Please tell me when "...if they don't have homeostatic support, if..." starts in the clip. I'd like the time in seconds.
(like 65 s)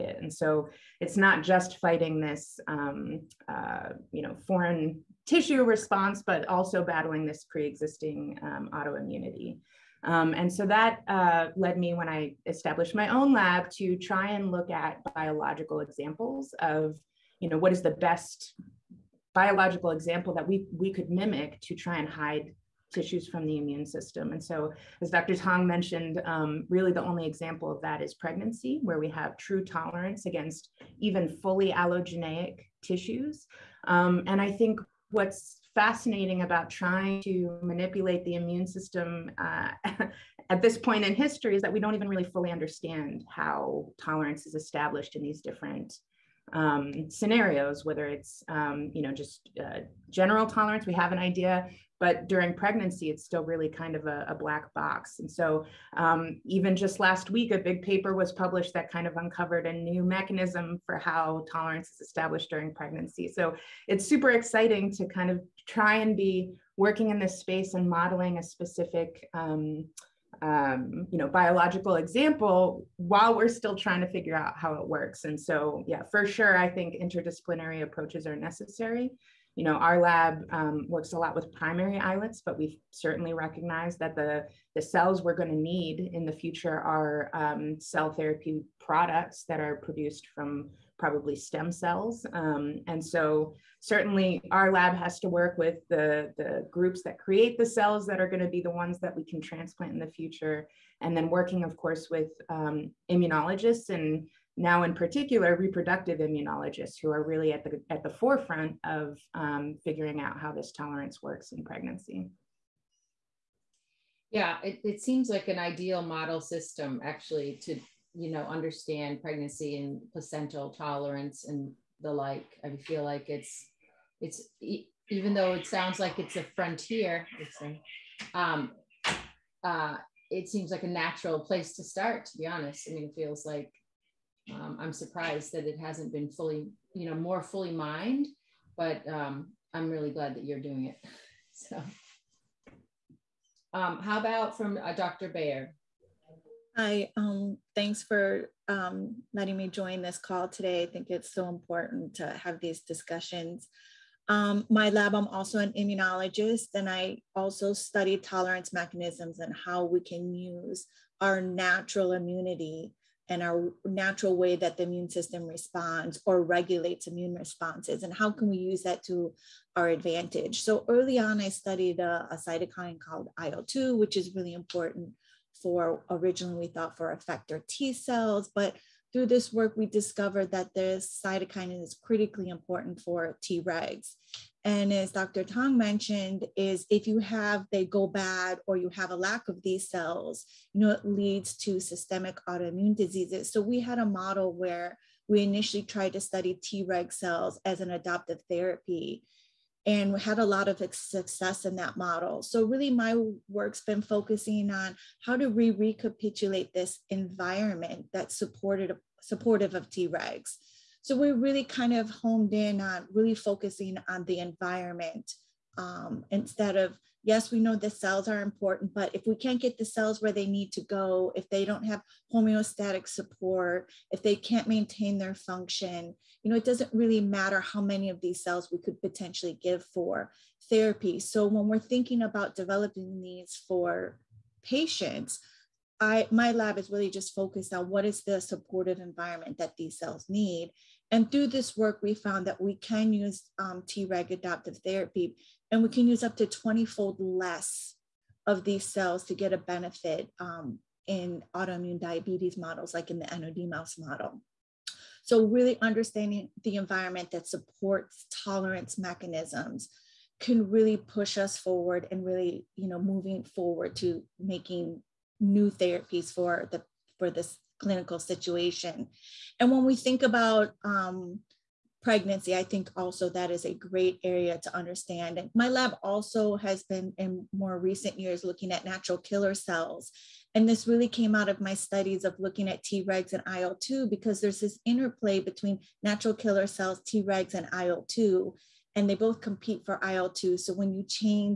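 221 s.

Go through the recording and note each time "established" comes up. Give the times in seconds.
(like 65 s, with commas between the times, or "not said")
12 s, 44 s, 62 s.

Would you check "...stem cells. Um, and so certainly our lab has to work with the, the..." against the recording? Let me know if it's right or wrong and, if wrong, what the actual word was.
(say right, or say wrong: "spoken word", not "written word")
right.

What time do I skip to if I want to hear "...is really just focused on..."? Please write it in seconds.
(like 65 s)
236 s.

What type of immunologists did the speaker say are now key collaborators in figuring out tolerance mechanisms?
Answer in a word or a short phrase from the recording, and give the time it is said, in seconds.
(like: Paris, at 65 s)
Reproductive immunologists, at 105 s.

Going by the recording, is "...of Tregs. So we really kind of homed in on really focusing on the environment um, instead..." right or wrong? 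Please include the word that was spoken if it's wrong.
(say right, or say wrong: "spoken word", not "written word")
right.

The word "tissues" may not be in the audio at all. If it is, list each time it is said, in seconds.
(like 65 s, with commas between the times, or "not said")
5 s, 22 s, 32 s.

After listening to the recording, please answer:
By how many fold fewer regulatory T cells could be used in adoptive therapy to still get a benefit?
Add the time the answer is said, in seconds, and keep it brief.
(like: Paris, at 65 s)
20, at 246 s.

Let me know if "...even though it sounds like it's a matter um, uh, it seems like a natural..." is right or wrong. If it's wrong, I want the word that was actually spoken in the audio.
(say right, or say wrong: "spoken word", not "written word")
wrong: "frontier", not "matter".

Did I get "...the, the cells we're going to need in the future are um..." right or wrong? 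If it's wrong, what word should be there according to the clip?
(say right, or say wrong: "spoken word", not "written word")
right.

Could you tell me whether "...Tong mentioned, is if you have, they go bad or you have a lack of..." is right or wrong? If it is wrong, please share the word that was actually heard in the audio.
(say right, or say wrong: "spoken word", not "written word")
right.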